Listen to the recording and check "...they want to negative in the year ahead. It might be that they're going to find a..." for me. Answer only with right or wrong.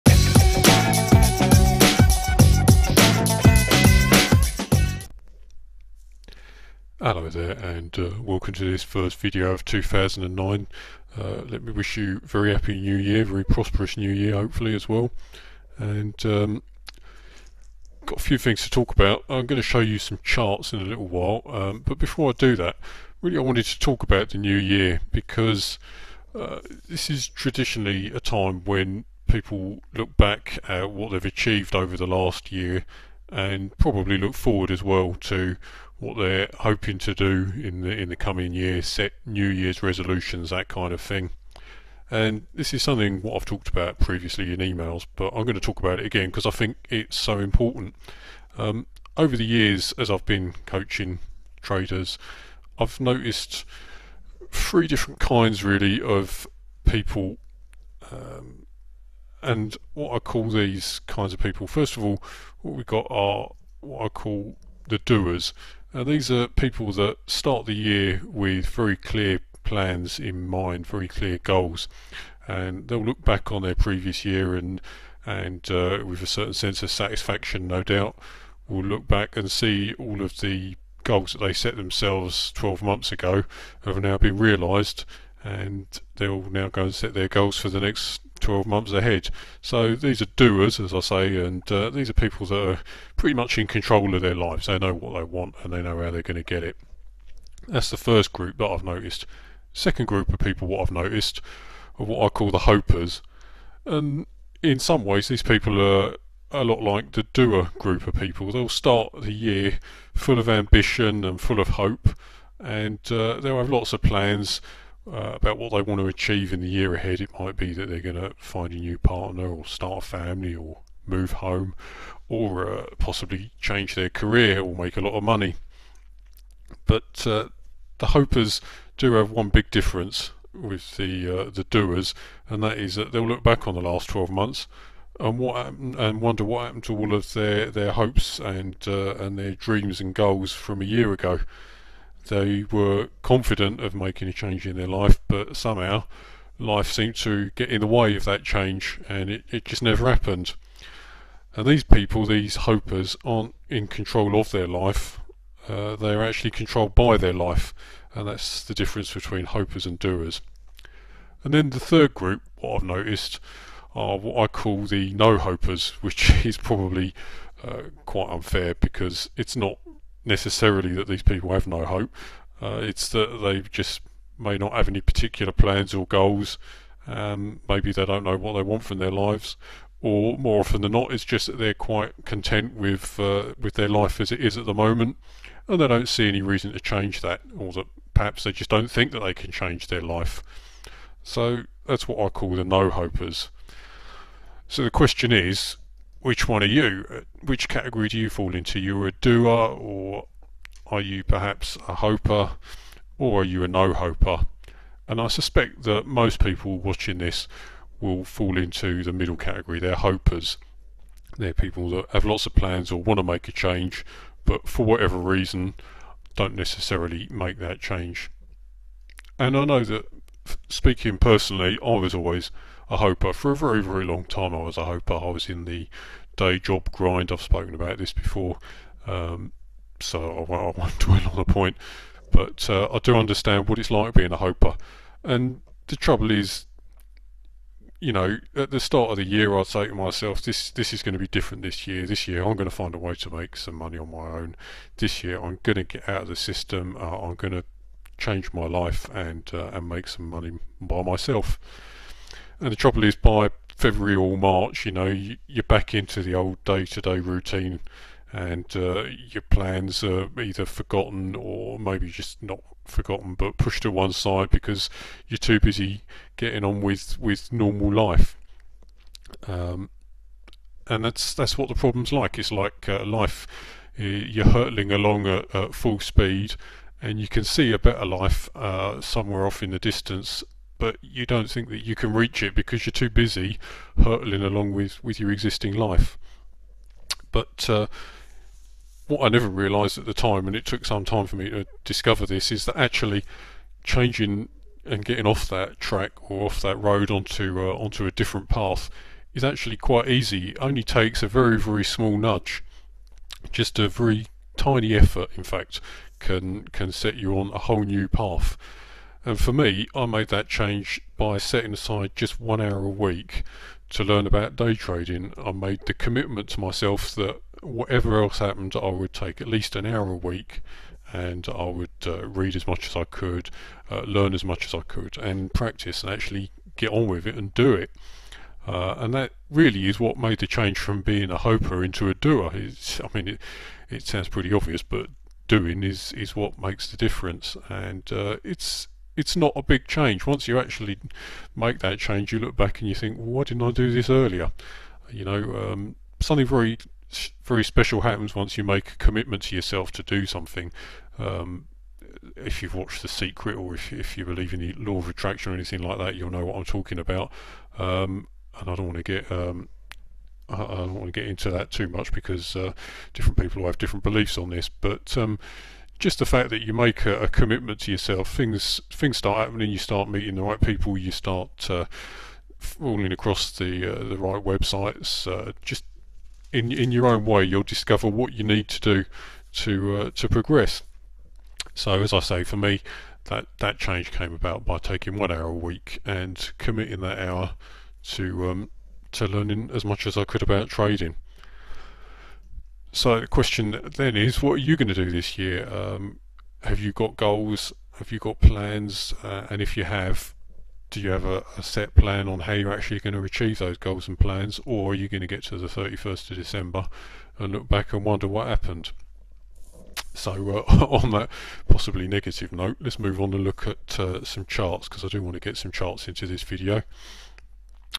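wrong.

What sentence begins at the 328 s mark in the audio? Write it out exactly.
Uh, and that really is what made the change from being a hoper into a doer.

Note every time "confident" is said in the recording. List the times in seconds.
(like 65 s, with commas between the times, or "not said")
143 s.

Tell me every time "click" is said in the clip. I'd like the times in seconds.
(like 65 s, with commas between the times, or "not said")
not said.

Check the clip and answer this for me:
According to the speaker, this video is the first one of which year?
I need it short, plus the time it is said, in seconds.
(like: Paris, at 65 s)
2009, at 9 s.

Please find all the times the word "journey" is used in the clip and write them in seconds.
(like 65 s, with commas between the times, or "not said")
not said.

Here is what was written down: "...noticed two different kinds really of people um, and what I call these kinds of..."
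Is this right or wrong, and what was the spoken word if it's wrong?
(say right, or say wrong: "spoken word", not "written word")
wrong: "three", not "two".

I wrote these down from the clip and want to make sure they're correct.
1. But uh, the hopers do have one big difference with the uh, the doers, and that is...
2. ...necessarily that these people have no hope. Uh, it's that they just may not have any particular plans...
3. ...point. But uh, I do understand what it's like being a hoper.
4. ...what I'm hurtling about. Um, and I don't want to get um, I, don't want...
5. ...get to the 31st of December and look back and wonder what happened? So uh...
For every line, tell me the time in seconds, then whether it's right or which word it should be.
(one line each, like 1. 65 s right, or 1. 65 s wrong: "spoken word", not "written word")
1. 126 s right
2. 170 s right
3. 231 s right
4. 356 s wrong: "talking", not "hurtling"
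5. 405 s right.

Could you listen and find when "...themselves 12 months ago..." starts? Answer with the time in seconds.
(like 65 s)
81 s.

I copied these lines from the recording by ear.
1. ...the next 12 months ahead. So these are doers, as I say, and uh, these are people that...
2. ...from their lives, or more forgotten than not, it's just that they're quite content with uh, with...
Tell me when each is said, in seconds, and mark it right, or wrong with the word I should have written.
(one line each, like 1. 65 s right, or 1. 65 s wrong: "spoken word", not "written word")
1. 87 s right
2. 178 s wrong: "often", not "forgotten".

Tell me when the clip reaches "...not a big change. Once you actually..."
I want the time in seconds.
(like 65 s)
339 s.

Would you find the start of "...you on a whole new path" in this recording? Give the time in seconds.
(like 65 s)
307 s.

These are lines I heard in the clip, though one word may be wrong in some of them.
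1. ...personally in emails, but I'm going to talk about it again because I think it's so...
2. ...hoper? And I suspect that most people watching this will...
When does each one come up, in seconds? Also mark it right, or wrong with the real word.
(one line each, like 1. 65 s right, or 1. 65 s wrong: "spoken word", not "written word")
1. 43 s wrong: "previously", not "personally"
2. 203 s right.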